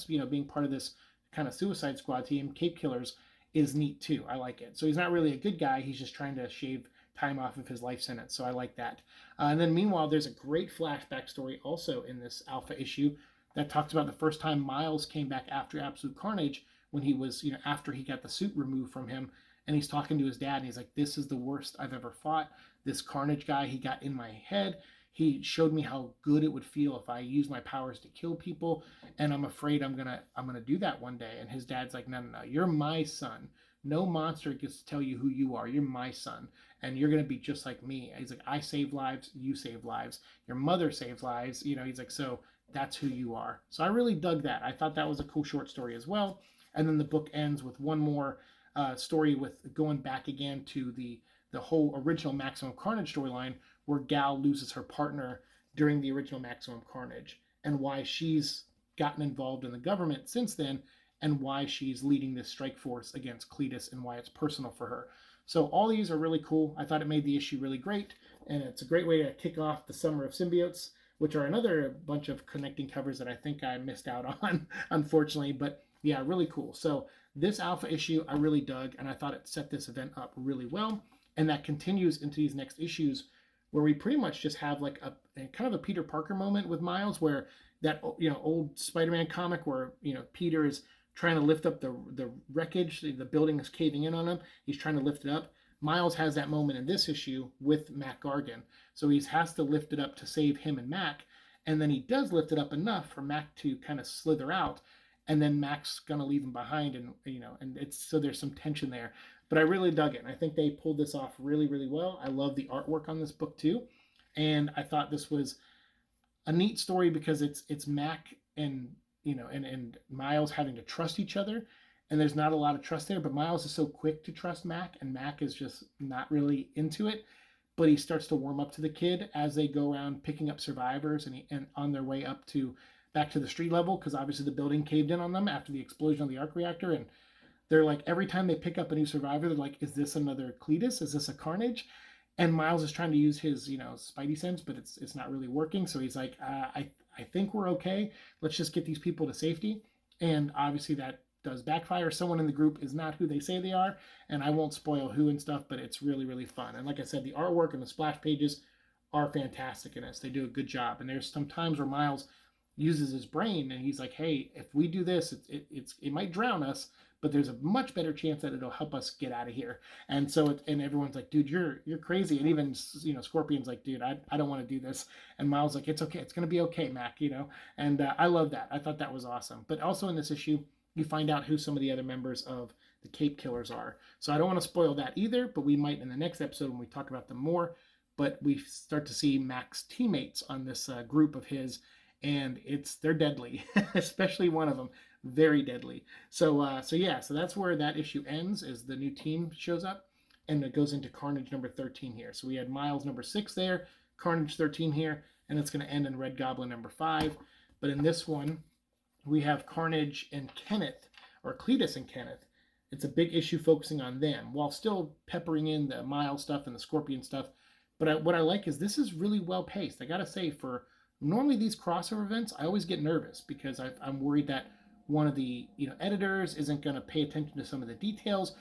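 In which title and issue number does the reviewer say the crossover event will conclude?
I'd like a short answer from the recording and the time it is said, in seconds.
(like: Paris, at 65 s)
Red Goblin #5, at 206 s.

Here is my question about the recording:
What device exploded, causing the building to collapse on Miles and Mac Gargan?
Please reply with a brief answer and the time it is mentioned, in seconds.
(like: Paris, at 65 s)
arc reactor, at 136 s.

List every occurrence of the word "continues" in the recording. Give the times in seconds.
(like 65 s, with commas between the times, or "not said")
81 s.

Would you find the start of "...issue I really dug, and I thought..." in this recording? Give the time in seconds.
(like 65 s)
77 s.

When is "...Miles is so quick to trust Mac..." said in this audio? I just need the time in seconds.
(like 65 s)
123 s.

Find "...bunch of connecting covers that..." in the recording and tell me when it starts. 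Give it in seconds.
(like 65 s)
72 s.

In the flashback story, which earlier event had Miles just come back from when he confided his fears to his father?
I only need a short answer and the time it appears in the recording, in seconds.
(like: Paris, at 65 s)
Absolute Carnage, at 15 s.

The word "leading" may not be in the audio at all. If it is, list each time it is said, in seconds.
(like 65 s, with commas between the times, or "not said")
62 s.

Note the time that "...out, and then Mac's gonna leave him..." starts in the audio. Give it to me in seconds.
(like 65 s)
104 s.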